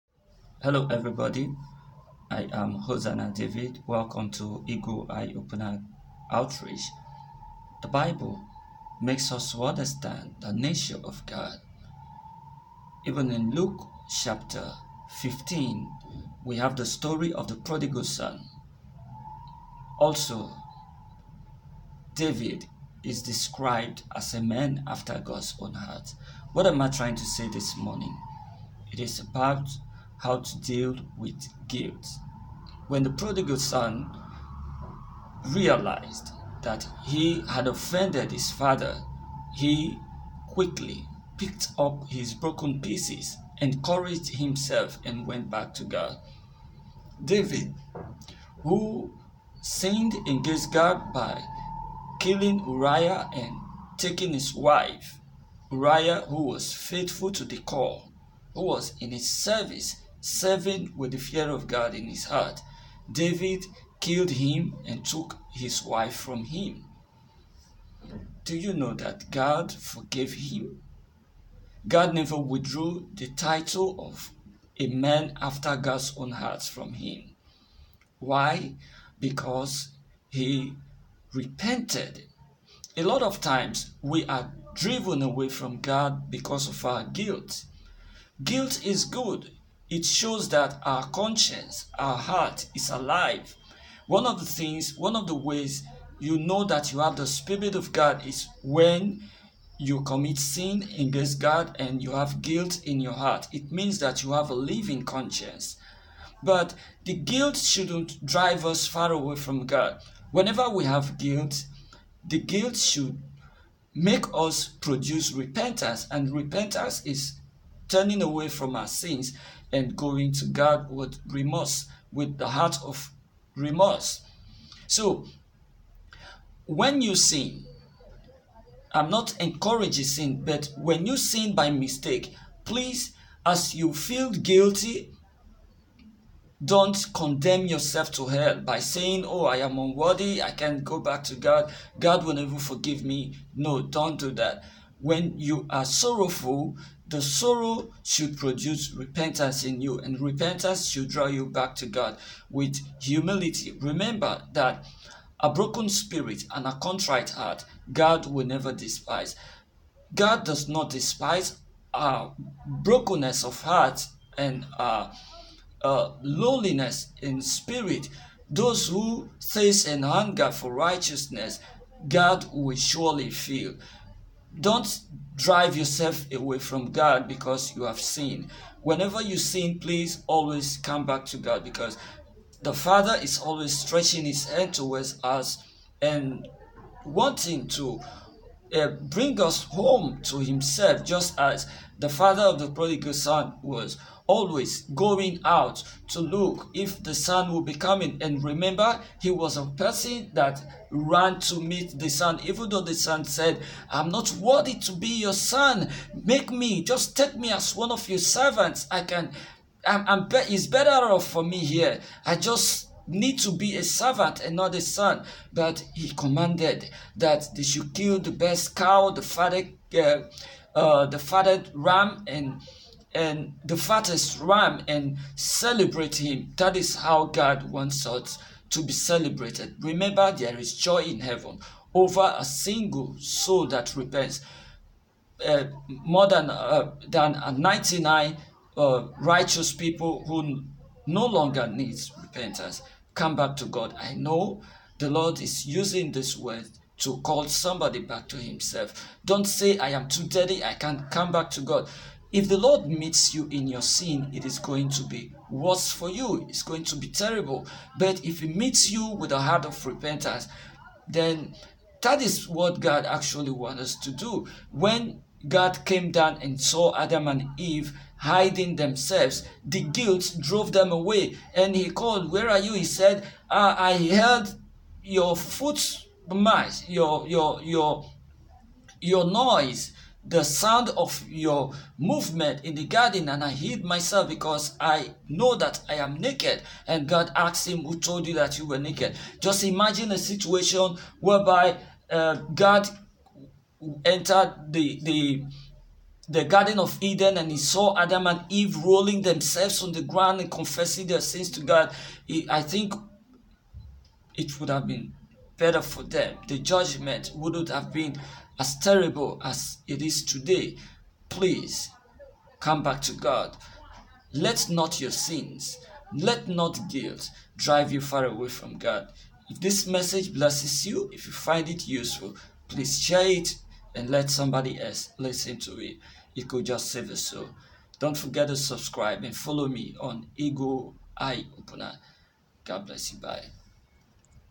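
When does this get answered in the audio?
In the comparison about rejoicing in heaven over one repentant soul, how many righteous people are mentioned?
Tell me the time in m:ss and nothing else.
3:57.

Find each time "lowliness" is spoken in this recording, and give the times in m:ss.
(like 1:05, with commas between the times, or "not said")
2:46.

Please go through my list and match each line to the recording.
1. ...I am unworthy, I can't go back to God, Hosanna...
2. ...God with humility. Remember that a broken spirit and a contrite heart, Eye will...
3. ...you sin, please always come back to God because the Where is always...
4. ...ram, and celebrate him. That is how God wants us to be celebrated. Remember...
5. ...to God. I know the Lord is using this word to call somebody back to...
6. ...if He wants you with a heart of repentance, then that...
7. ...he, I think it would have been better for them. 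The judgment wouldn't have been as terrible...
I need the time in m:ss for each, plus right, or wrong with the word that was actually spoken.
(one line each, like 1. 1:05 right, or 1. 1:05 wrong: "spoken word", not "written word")
1. 2:19 wrong: "God", not "Hosanna"
2. 2:31 wrong: "God", not "Eye"
3. 2:59 wrong: "Father", not "Where"
4. 3:44 right
5. 4:03 right
6. 4:18 wrong: "meets", not "wants"
7. 5:02 right.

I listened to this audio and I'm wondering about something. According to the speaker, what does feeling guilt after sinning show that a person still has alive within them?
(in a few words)
A living conscience.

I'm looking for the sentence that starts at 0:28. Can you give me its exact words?
It is about how to deal with guilt.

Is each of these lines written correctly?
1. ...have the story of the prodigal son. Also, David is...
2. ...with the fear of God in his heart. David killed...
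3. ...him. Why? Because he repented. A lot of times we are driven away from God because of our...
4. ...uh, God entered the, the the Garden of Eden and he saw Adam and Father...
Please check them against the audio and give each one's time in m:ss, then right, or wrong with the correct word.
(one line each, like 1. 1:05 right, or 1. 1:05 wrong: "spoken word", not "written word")
1. 0:16 right
2. 1:00 right
3. 1:16 right
4. 4:52 wrong: "Eve", not "Father".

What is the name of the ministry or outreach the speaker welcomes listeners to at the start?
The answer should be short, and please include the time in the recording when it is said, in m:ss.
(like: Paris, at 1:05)
Eagle Eye Opener Outreach, at 0:04.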